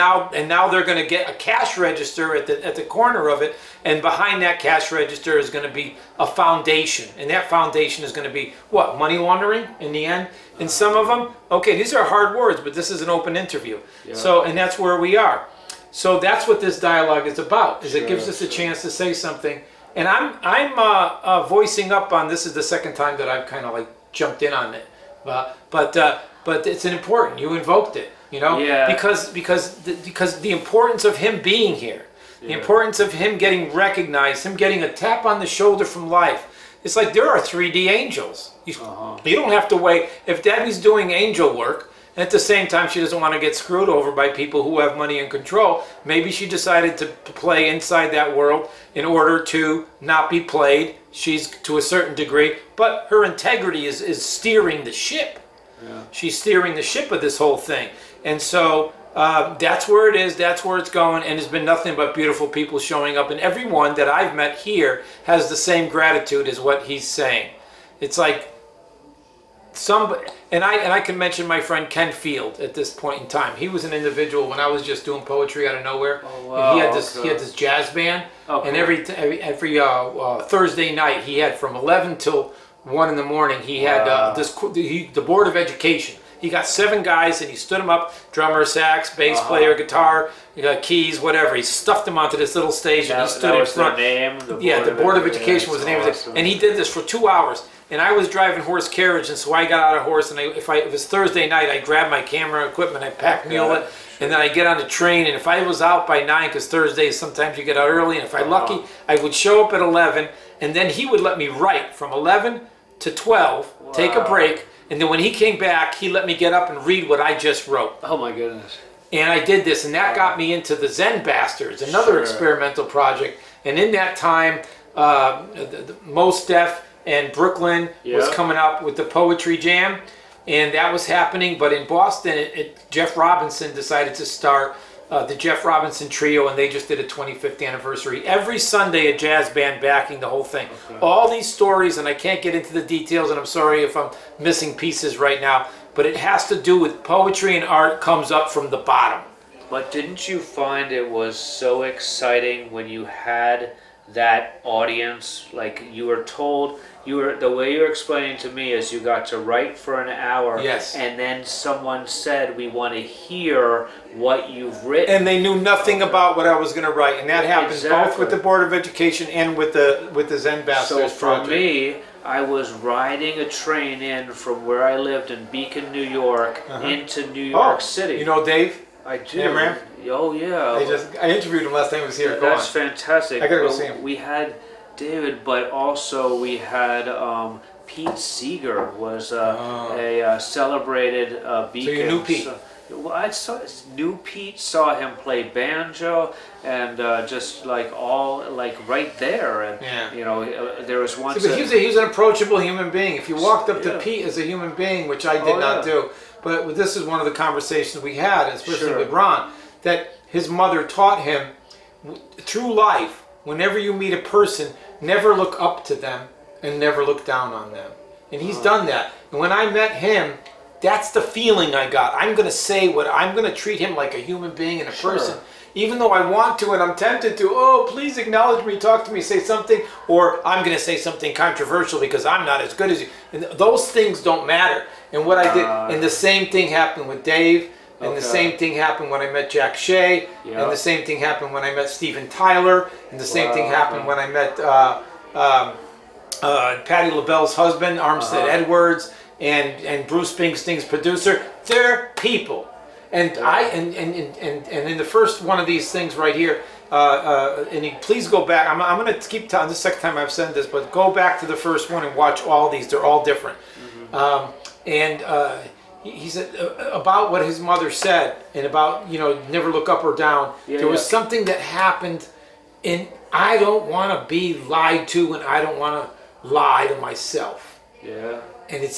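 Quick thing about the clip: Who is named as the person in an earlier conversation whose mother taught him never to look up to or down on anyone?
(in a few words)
Ron.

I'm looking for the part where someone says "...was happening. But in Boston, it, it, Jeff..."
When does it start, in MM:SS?
02:10.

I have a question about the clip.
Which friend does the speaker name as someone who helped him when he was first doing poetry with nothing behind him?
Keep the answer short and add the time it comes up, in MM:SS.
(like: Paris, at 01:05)
Ken Field, at 01:11.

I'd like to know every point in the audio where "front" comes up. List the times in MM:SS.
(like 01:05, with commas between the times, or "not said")
01:33.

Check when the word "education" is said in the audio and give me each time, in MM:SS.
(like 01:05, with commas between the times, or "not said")
01:25, 01:35, 02:48.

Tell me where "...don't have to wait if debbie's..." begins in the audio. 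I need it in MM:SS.
00:39.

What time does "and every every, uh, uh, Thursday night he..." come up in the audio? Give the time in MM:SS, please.
01:18.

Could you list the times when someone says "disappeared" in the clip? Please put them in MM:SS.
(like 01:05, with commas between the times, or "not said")
not said.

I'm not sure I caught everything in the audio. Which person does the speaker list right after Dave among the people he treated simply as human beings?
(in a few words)
Jack Shea.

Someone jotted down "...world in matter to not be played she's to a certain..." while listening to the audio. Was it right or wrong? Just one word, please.
wrong.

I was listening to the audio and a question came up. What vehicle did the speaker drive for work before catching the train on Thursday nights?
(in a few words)
Horse carriage.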